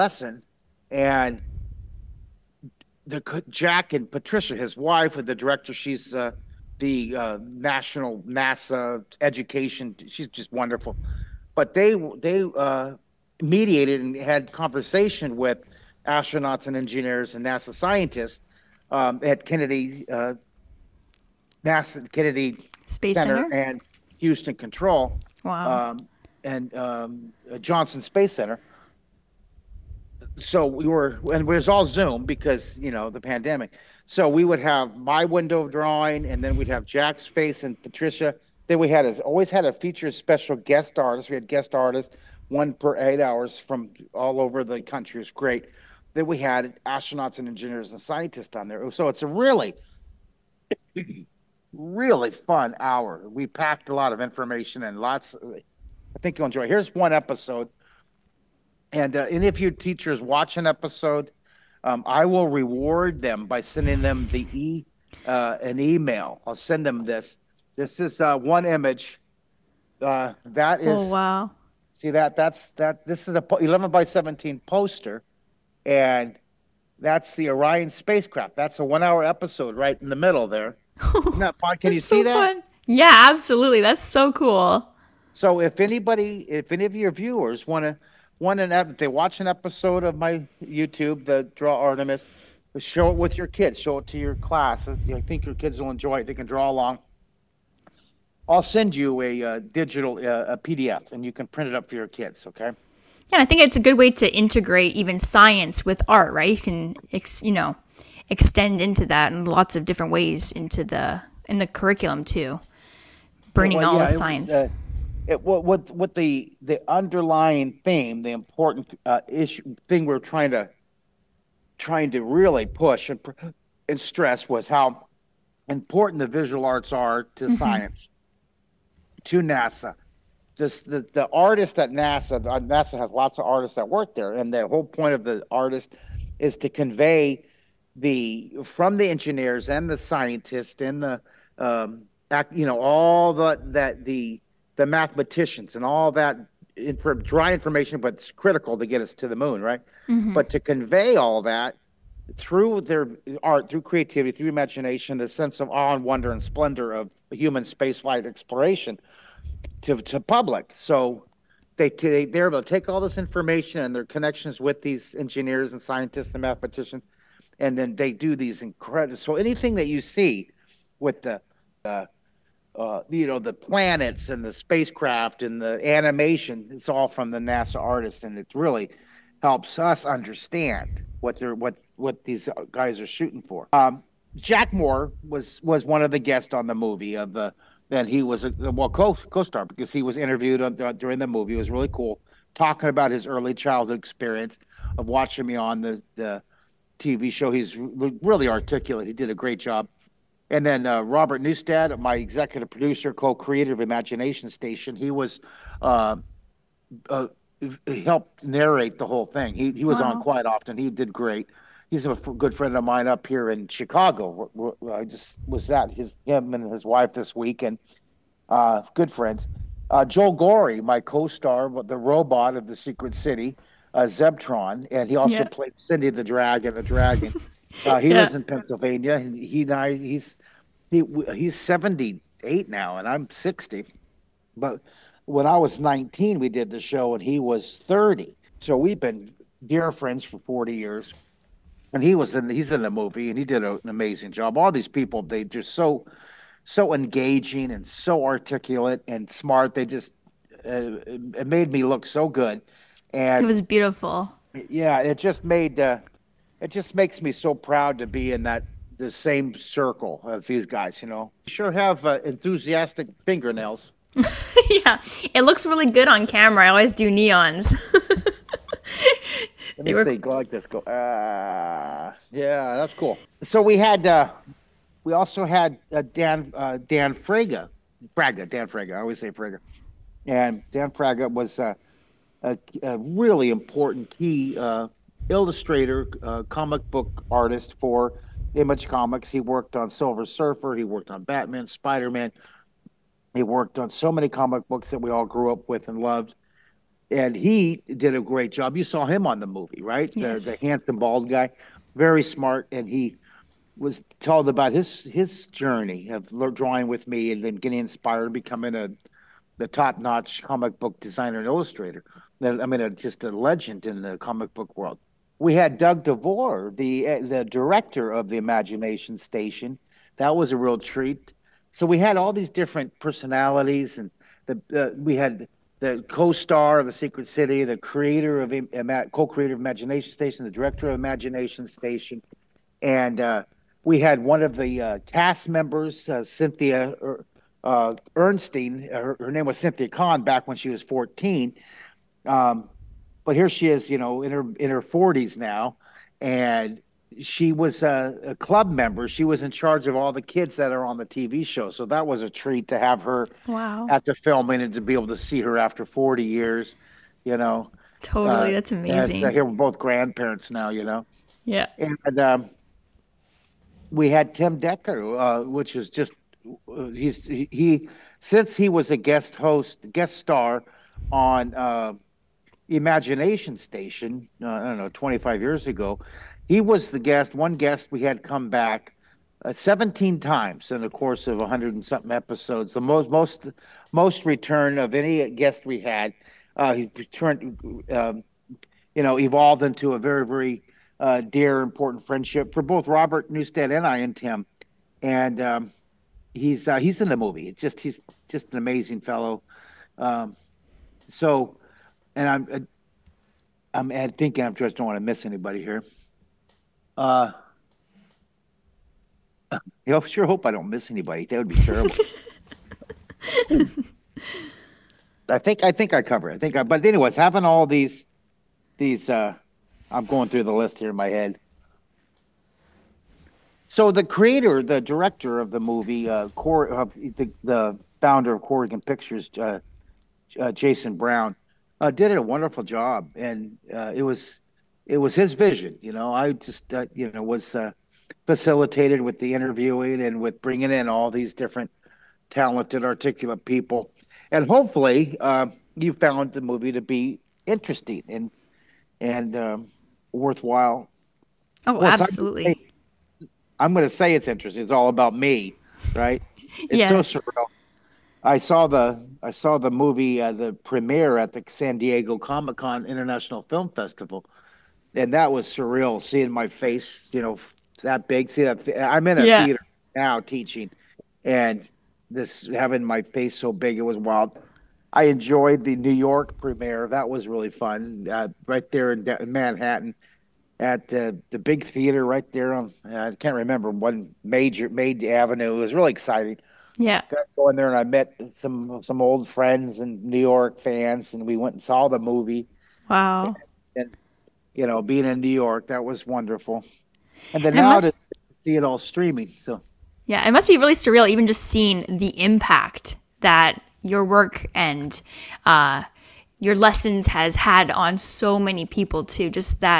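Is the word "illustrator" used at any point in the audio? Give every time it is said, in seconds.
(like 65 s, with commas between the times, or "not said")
285 s, 311 s.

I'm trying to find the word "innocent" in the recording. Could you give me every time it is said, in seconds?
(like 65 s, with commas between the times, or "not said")
not said.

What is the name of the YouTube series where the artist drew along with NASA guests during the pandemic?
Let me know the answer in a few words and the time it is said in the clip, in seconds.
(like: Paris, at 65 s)
Draw Artemis, at 91 s.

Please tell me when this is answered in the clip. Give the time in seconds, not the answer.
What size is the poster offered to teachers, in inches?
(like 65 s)
73 s.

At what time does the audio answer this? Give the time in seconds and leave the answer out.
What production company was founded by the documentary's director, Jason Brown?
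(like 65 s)
428 s.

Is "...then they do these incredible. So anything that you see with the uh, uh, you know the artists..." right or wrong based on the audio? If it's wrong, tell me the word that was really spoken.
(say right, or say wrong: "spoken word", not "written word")
wrong: "planets", not "artists".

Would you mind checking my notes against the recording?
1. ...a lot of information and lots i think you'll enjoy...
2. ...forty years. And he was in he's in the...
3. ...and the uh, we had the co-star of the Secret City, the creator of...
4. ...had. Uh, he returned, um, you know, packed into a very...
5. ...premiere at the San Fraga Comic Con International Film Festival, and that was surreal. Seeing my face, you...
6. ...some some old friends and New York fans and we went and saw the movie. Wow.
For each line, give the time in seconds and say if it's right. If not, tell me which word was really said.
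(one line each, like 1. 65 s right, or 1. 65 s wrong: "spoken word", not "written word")
1. 53 s right
2. 240 s right
3. 323 s right
4. 385 s wrong: "evolved", not "packed"
5. 460 s wrong: "Diego", not "Fraga"
6. 488 s right.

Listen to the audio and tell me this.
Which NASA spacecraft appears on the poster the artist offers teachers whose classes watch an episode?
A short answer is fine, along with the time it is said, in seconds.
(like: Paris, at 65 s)
Orion, at 77 s.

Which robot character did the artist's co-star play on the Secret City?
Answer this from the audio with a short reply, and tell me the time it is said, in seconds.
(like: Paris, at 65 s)
Zebtron, at 224 s.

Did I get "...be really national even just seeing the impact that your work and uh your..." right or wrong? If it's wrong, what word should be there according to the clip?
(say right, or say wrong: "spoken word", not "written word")
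wrong: "surreal", not "national".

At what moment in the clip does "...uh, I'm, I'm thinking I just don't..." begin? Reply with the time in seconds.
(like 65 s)
402 s.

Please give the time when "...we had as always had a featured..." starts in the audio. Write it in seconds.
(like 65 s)
38 s.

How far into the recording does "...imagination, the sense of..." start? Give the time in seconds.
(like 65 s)
154 s.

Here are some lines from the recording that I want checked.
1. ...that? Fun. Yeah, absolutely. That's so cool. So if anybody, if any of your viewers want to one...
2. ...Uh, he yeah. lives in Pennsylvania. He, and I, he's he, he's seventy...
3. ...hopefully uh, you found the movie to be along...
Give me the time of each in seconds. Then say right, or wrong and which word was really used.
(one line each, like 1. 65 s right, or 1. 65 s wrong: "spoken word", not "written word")
1. 82 s right
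2. 227 s right
3. 444 s wrong: "interesting", not "along".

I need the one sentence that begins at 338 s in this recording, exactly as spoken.
Her, her, name was Cynthia Kahn back when she was fourteen.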